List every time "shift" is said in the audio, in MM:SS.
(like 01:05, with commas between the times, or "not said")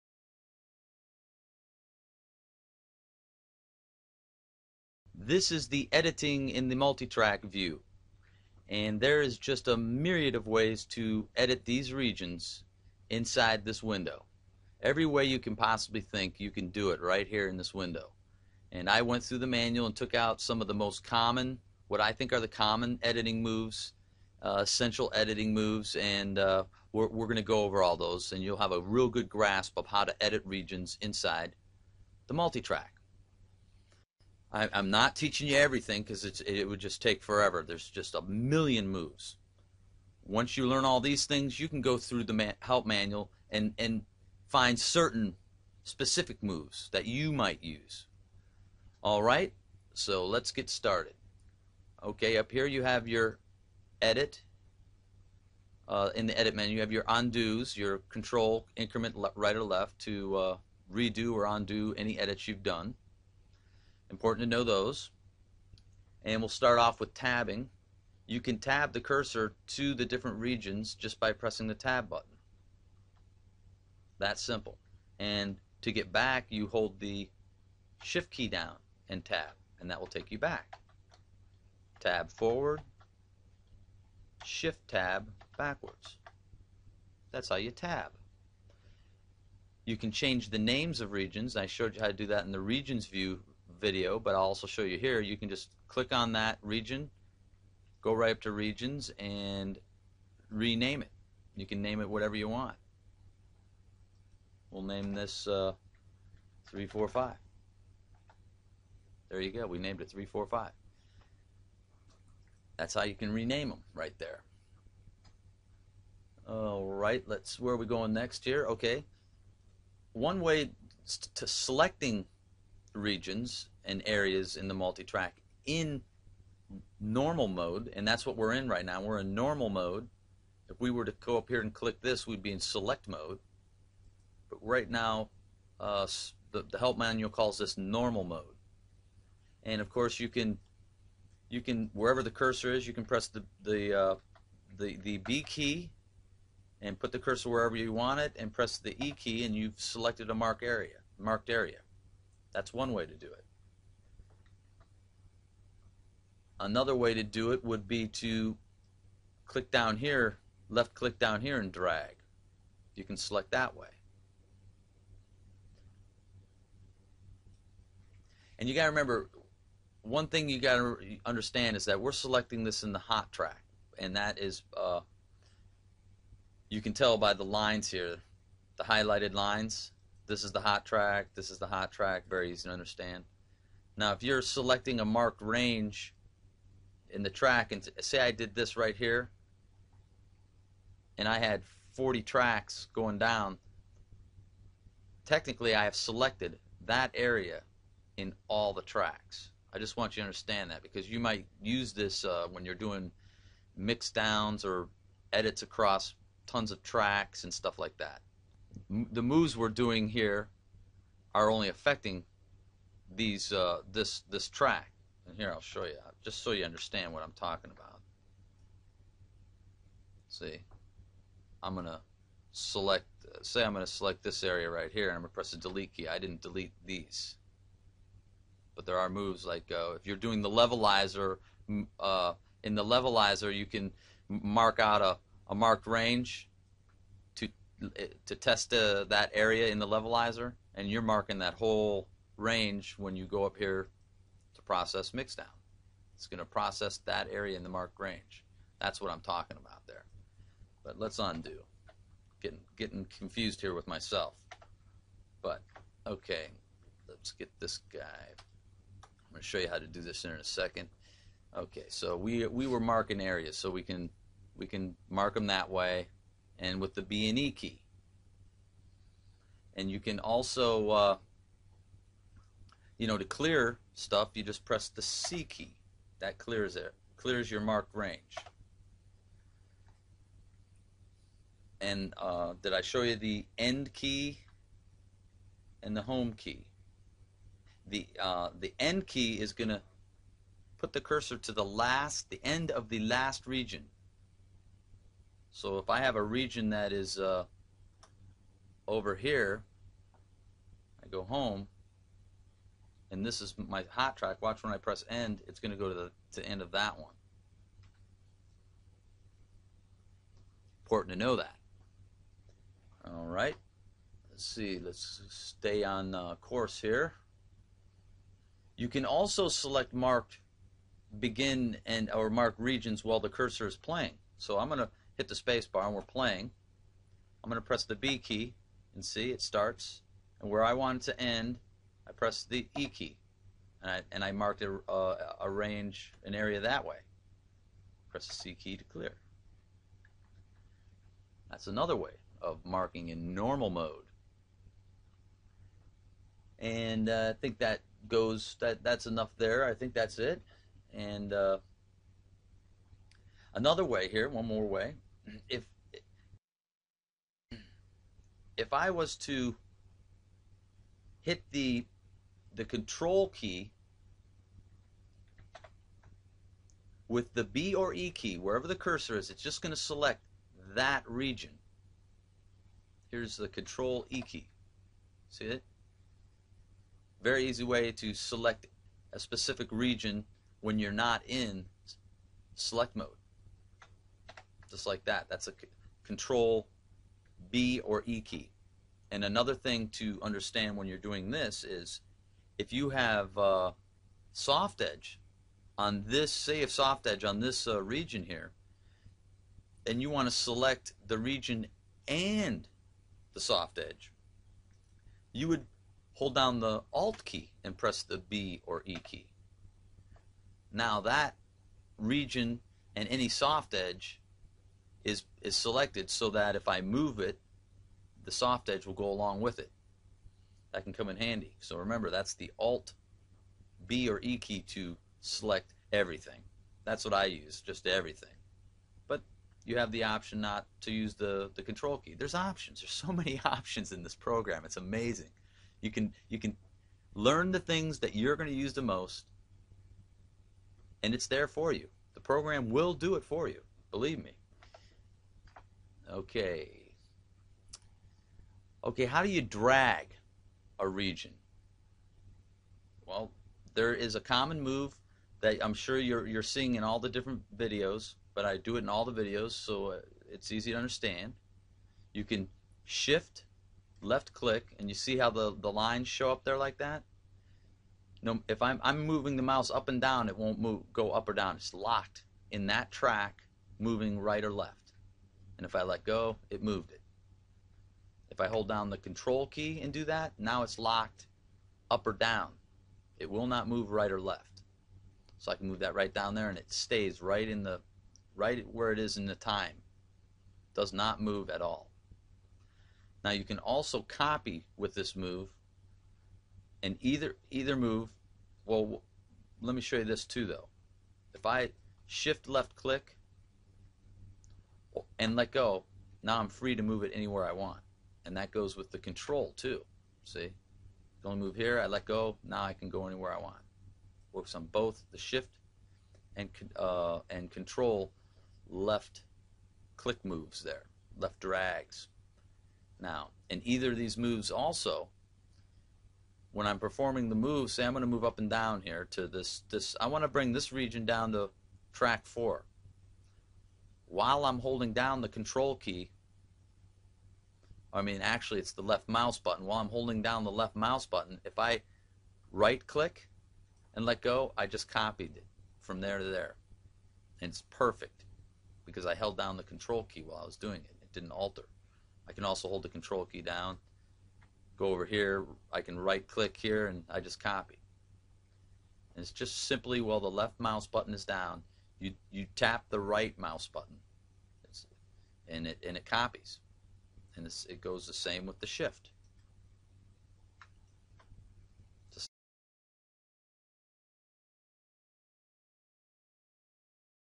01:18, 01:24, 07:42, 08:22, 08:35, 09:28.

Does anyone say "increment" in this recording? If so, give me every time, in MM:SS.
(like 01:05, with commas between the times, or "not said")
00:58.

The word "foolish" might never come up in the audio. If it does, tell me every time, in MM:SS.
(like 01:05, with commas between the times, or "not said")
not said.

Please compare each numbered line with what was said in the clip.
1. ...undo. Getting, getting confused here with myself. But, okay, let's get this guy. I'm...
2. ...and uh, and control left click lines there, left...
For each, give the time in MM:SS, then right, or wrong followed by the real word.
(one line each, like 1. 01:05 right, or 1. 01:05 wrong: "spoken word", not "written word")
1. 04:11 right
2. 08:36 wrong: "moves", not "lines".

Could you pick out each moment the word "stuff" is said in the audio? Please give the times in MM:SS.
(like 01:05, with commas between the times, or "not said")
03:27, 04:33.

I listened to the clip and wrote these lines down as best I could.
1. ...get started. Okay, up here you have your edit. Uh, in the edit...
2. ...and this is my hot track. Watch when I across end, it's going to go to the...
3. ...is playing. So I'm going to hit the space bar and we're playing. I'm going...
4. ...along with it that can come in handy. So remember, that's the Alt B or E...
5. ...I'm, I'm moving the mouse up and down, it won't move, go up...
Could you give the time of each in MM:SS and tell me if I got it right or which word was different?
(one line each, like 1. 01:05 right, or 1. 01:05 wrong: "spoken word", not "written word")
1. 00:50 right
2. 05:03 wrong: "press", not "across"
3. 05:23 right
4. 06:59 right
5. 07:48 right.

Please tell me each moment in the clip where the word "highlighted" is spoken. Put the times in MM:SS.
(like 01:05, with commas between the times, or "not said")
02:58.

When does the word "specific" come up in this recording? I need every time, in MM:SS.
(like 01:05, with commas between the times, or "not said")
00:45, 06:19.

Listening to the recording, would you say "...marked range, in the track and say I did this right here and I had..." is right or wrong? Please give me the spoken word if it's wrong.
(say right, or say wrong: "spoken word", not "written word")
right.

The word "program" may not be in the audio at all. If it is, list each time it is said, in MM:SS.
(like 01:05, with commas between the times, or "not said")
07:14, 07:22.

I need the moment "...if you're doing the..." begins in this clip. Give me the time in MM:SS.
03:49.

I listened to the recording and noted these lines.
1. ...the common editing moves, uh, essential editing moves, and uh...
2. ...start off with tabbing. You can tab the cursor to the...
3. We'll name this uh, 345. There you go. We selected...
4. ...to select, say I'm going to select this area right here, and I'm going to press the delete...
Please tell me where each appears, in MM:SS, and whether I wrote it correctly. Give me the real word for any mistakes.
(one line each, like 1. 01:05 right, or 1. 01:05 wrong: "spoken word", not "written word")
1. 00:22 right
2. 01:06 right
3. 01:44 wrong: "named", not "selected"
4. 03:41 right.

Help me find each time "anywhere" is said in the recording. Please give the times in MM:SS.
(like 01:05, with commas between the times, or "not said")
08:27, 08:33.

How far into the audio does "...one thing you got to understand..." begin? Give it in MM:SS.
02:50.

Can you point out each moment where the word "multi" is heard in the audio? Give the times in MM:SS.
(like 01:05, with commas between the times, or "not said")
00:06, 00:32, 02:04.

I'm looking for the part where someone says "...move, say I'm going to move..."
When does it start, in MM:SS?
08:47.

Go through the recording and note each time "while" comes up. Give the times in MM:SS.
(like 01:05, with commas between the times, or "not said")
05:23, 08:54, 08:59, 09:10, 09:19.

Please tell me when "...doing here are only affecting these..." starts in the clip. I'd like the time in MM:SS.
03:29.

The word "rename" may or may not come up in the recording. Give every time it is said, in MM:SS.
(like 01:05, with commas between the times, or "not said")
01:40, 01:53.